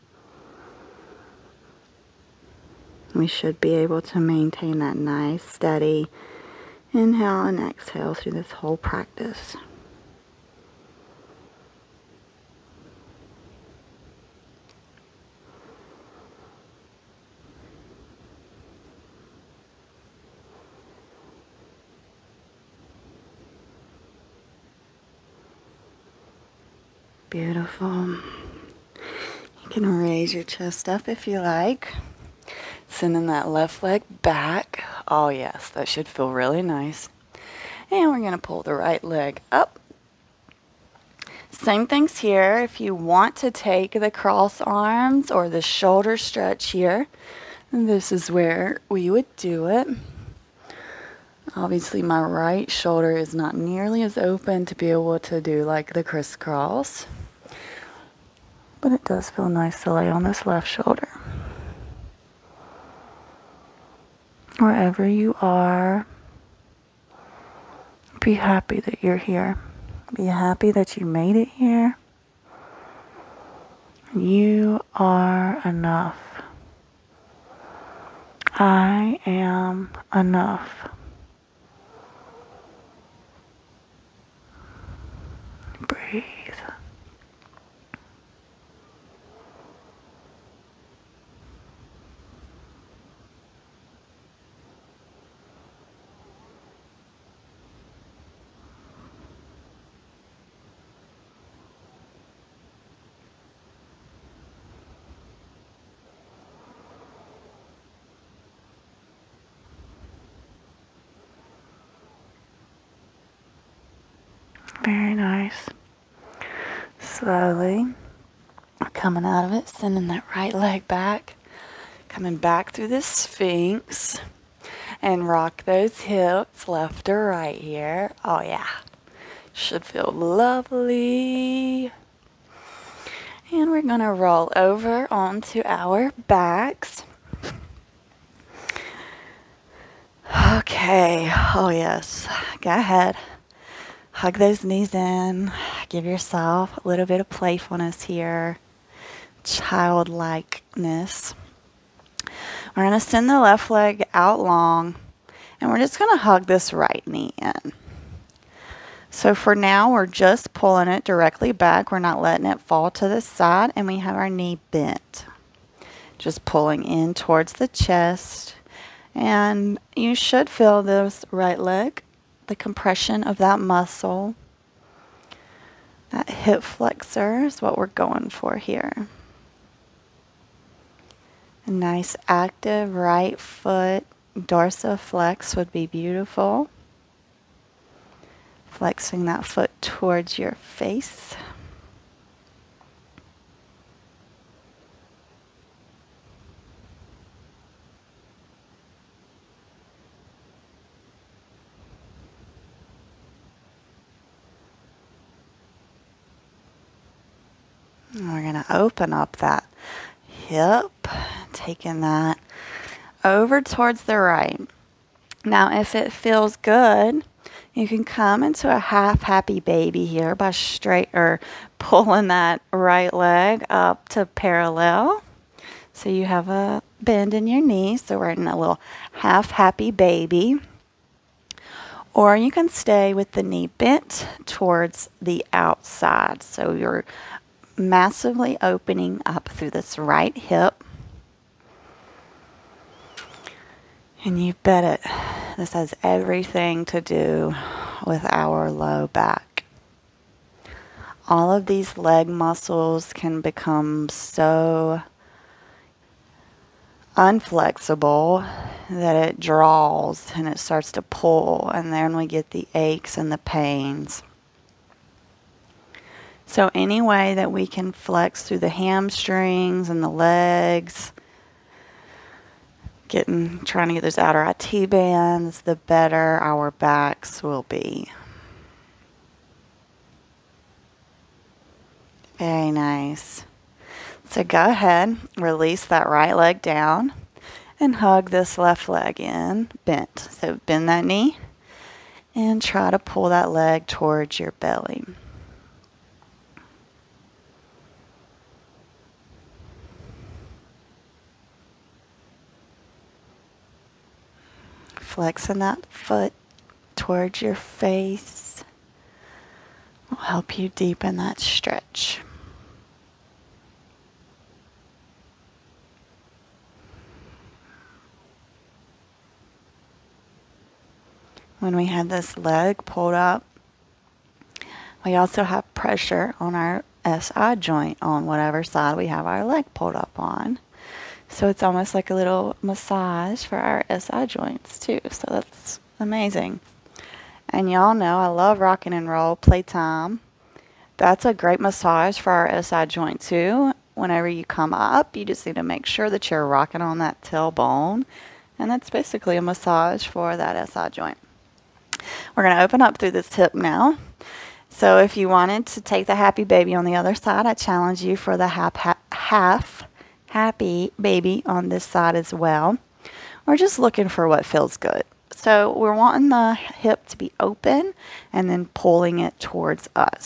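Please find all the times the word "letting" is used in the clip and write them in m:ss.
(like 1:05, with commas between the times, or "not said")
2:42.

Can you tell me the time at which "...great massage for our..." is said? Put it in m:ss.
5:41.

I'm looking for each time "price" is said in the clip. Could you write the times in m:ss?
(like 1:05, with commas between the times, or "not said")
not said.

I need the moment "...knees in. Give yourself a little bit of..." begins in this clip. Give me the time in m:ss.
2:24.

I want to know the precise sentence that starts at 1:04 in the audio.
Wherever you are, be happy that you're here.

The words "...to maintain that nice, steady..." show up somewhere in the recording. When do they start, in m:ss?
0:04.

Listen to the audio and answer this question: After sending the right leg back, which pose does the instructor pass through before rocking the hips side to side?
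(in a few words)
Sphinx.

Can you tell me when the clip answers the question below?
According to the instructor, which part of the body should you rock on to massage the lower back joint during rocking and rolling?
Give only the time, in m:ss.
5:47.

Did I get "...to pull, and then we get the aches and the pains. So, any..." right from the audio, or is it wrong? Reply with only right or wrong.
right.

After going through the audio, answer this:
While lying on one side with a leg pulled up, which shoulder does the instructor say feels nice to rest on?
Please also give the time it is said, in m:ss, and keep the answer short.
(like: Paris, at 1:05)
Left shoulder, at 1:00.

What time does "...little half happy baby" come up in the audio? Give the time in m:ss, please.
3:48.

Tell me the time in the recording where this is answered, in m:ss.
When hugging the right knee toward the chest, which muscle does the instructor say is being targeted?
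2:56.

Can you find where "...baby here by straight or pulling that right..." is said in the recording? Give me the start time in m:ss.
3:39.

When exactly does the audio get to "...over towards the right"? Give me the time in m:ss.
3:33.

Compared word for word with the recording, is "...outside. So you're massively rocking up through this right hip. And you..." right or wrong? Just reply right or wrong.
wrong.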